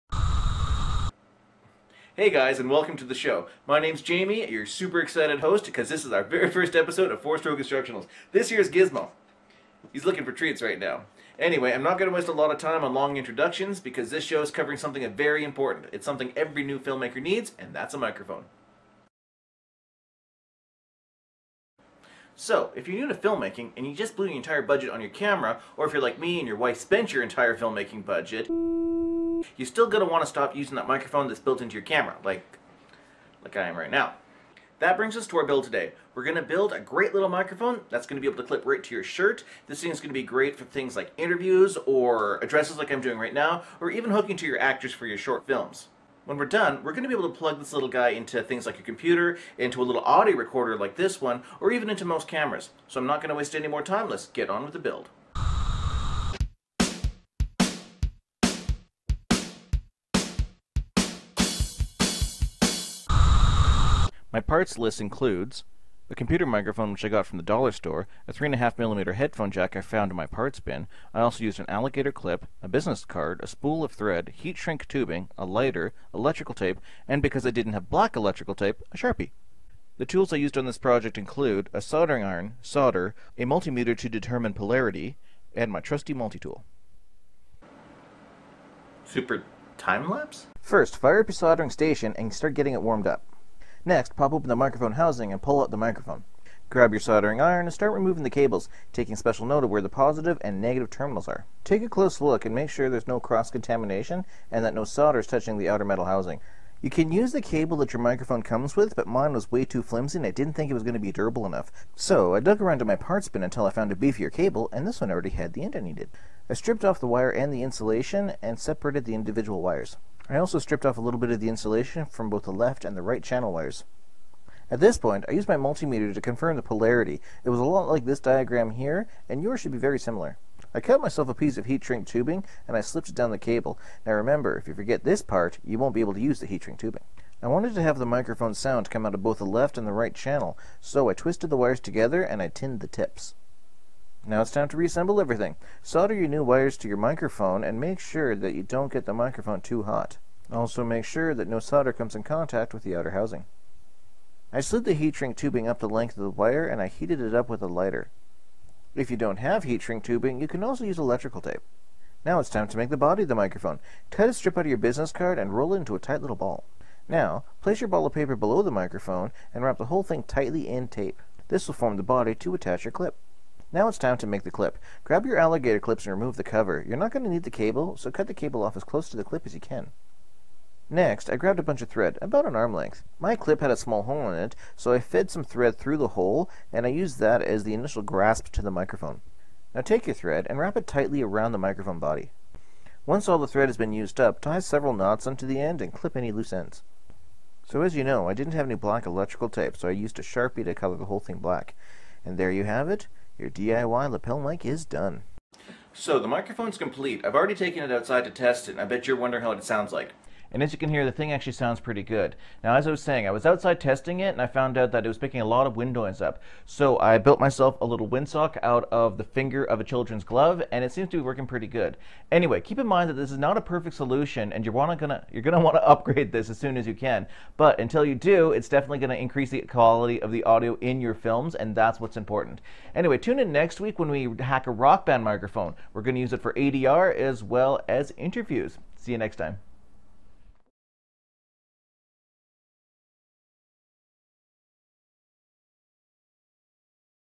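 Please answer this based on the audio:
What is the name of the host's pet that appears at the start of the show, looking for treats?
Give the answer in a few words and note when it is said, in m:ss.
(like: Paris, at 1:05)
Gizmo, at 0:08.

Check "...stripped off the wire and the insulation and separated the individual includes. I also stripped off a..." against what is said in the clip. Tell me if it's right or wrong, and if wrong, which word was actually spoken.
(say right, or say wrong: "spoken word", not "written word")
wrong: "wires", not "includes".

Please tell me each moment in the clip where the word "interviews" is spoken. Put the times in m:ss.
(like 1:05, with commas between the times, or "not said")
0:41, 3:58.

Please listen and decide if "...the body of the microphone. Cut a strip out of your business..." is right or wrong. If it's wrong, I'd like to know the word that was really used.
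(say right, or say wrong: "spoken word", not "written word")
right.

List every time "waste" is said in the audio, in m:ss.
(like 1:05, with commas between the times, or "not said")
0:12, 0:53.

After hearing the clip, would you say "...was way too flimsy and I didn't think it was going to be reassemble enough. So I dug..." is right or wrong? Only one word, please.
wrong.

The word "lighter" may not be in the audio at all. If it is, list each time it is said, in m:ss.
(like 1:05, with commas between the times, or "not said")
1:15, 2:37.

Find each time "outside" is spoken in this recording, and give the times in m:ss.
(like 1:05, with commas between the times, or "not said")
3:27, 3:33.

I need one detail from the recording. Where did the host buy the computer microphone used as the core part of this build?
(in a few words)
the dollar store.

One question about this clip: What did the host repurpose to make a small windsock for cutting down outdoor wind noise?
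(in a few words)
finger of a children's glove.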